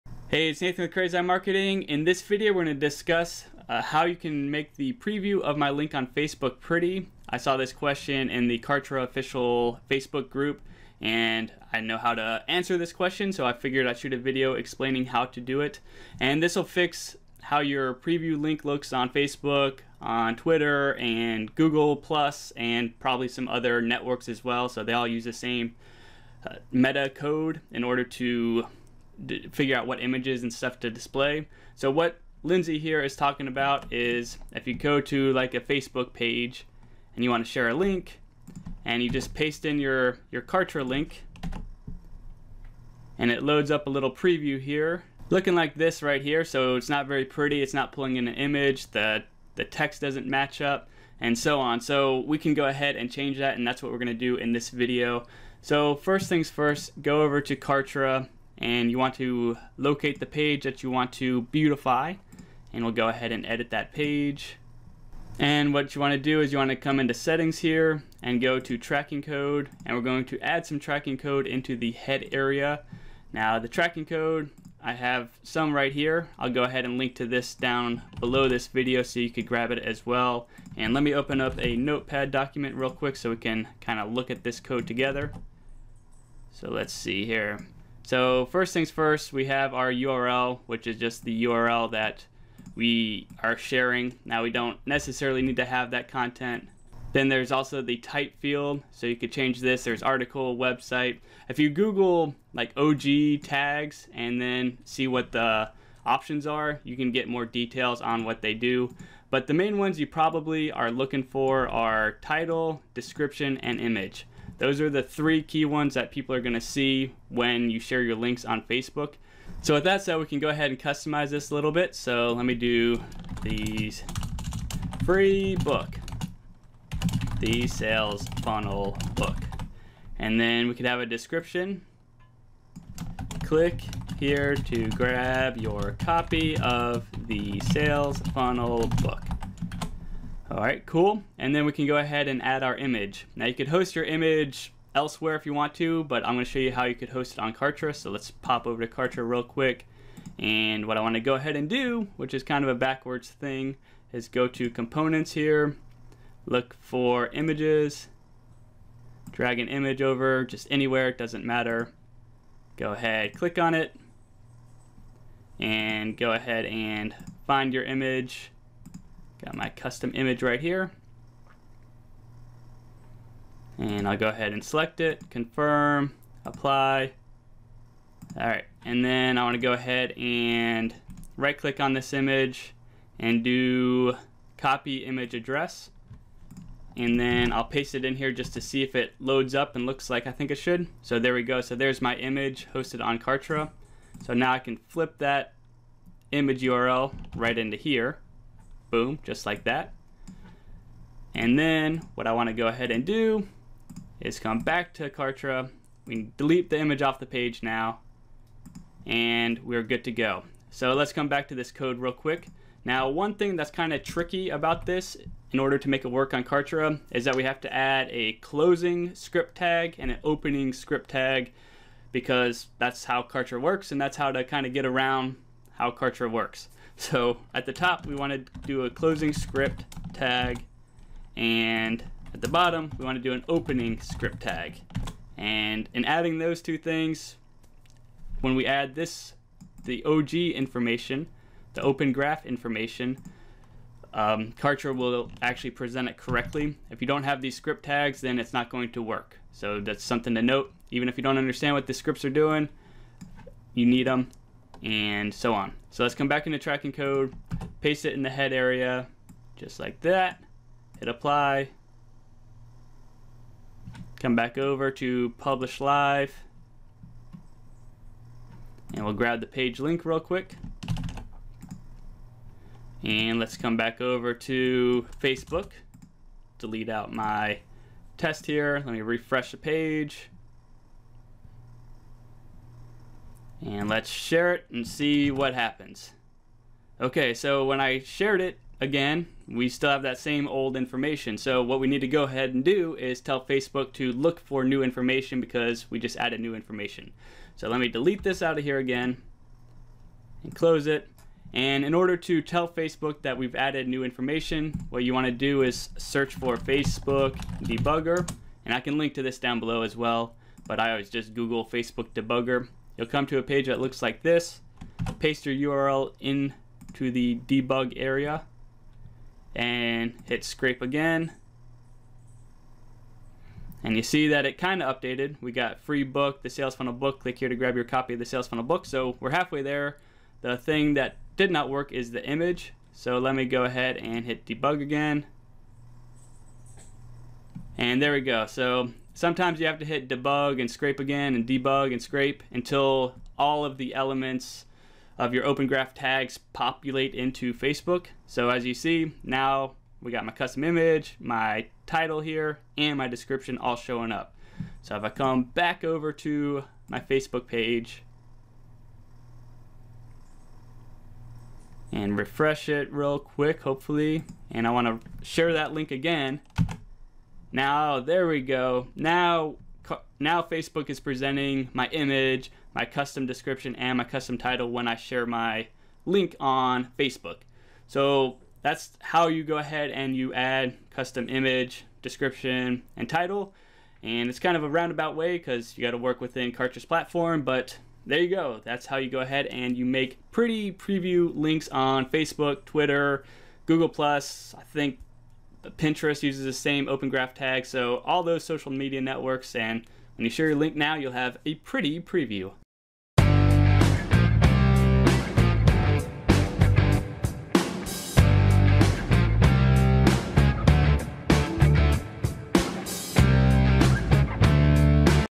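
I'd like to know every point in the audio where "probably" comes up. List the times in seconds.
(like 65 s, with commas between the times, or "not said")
23 s, 110 s.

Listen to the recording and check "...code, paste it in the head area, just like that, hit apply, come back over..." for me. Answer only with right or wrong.
right.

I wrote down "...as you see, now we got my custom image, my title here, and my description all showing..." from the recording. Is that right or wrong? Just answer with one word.
right.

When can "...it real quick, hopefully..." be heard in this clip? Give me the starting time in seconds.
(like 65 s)
362 s.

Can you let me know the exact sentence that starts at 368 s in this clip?
Now, now Facebook is presenting my image, my custom description, and my custom title when I share my link on Facebook.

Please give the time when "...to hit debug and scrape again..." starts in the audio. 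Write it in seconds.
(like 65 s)
339 s.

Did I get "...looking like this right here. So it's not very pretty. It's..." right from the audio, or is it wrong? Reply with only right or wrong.
right.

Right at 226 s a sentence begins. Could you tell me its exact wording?
So at the top, we want to do a closing script tag.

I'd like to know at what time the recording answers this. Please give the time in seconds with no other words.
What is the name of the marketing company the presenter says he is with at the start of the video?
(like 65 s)
0 s.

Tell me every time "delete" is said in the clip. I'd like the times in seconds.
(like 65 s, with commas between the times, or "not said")
206 s, 276 s, 297 s.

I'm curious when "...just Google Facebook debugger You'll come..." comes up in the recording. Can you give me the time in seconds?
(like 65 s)
311 s.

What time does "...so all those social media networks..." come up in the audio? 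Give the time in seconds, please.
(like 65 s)
397 s.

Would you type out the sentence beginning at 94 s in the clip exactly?
Now we don't necessarily need to have that content.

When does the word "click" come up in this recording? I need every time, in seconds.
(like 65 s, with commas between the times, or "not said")
133 s, 163 s, 181 s, 327 s.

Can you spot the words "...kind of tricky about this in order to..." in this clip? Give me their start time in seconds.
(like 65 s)
213 s.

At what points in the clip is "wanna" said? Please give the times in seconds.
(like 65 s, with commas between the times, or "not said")
150 s, 179 s, 364 s.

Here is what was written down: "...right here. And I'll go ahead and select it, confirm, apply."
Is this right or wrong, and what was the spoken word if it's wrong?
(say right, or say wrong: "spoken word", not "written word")
right.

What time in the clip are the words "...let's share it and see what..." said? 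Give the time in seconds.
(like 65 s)
283 s.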